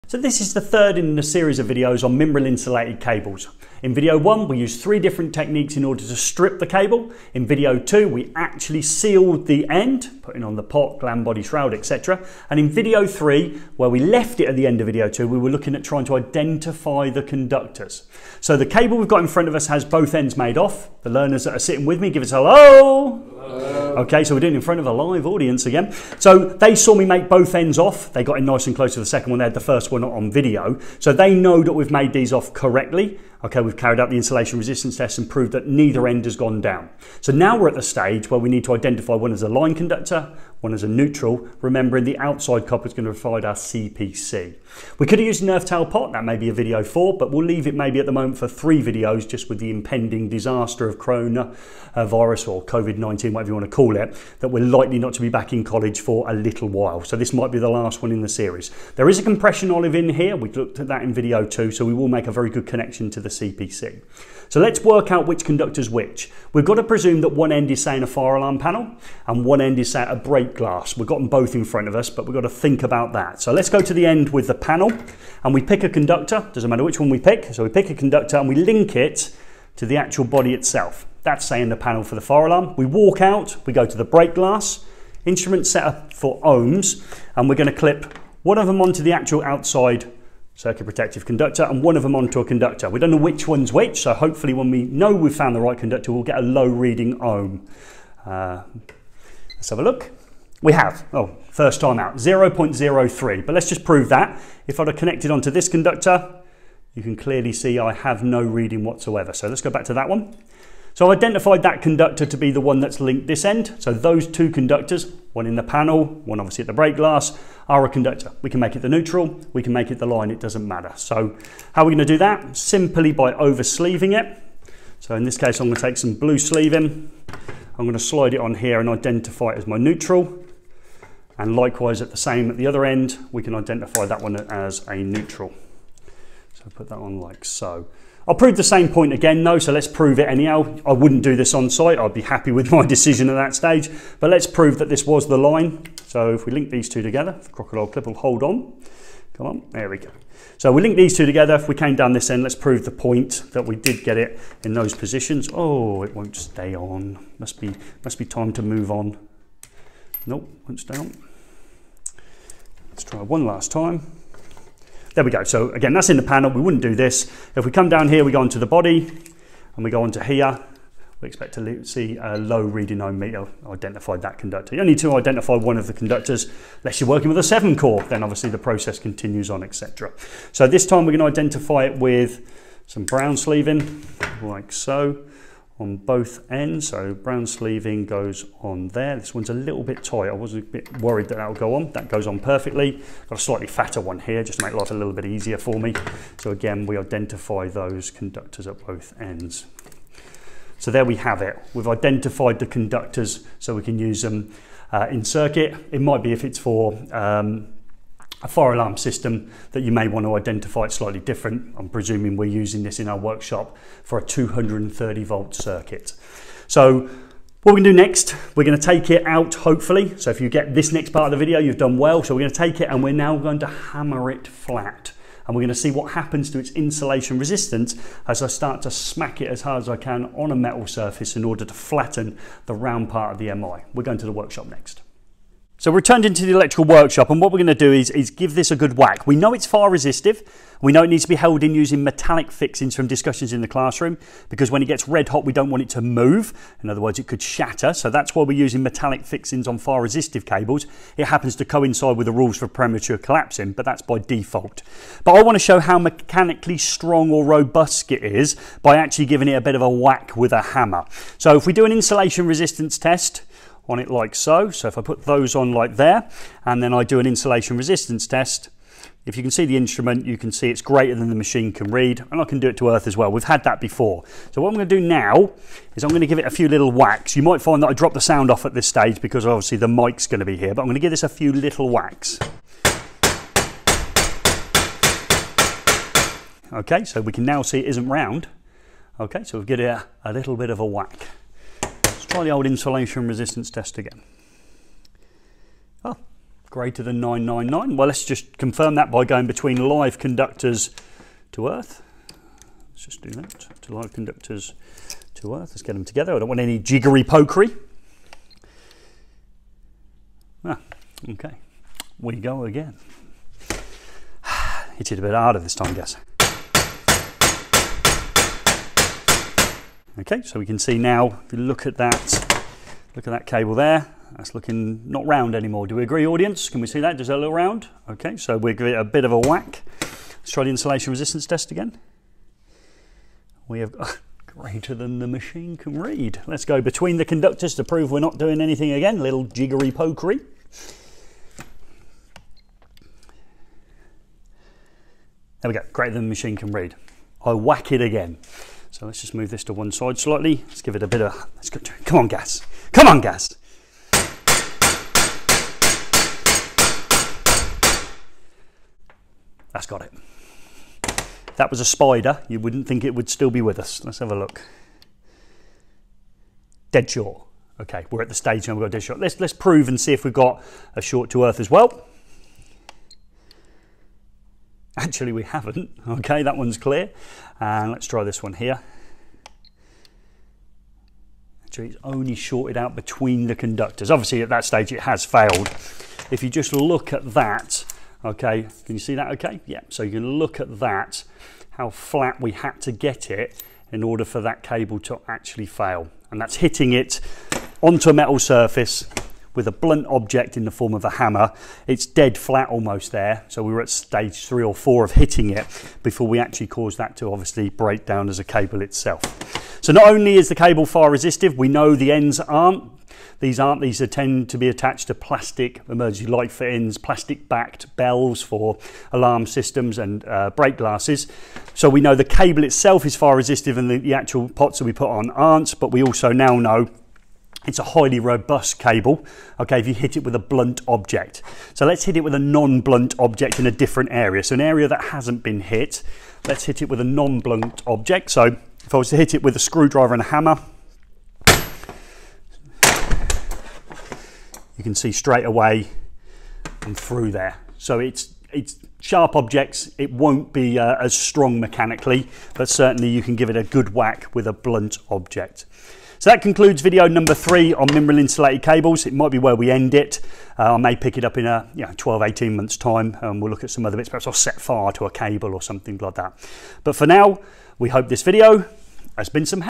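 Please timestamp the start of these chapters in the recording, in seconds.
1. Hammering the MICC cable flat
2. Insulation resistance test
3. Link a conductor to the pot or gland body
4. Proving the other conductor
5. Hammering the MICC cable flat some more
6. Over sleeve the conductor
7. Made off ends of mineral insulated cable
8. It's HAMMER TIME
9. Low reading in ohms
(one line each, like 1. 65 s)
1. 282 s
2. 266 s
3. 78 s
4. 173 s
5. 316 s
6. 129 s
7. 22 s
8. 236 s
9. 102 s.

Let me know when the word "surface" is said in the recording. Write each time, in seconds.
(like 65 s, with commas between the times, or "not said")
230 s, 398 s.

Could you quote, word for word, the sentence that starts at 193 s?
Got a slightly fatter one here just to make life a little bit easier for me.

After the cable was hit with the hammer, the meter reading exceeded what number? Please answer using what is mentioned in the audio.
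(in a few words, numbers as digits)
999.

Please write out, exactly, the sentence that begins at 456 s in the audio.
So that concludes video number three on mineral insulated cables.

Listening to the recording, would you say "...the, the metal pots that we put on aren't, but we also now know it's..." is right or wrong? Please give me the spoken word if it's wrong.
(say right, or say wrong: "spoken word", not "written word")
wrong: "actual", not "metal".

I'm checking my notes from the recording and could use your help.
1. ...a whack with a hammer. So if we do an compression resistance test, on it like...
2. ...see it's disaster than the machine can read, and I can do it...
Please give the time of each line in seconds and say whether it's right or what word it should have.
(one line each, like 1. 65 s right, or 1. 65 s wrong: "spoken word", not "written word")
1. 259 s wrong: "insulation", not "compression"
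2. 270 s wrong: "greater", not "disaster".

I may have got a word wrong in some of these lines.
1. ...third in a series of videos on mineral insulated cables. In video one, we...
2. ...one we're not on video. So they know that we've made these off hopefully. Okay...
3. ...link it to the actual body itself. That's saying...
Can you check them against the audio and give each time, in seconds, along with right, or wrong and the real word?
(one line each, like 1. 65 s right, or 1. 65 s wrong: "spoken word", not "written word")
1. 0 s right
2. 29 s wrong: "correctly", not "hopefully"
3. 78 s right.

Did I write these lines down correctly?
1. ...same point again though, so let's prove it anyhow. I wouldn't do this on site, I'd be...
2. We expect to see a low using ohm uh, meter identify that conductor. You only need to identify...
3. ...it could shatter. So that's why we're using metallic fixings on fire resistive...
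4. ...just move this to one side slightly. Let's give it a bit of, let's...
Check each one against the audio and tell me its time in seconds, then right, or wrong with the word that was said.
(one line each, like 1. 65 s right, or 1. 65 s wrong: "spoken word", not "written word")
1. 138 s right
2. 171 s wrong: "reading", not "using"
3. 247 s right
4. 349 s right.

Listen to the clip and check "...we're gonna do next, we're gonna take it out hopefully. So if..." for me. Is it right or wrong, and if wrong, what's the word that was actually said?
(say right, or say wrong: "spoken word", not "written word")
right.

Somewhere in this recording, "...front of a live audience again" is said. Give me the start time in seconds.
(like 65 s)
24 s.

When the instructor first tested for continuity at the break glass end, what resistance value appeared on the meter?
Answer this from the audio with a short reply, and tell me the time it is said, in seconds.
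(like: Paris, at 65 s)
0.03, at 102 s.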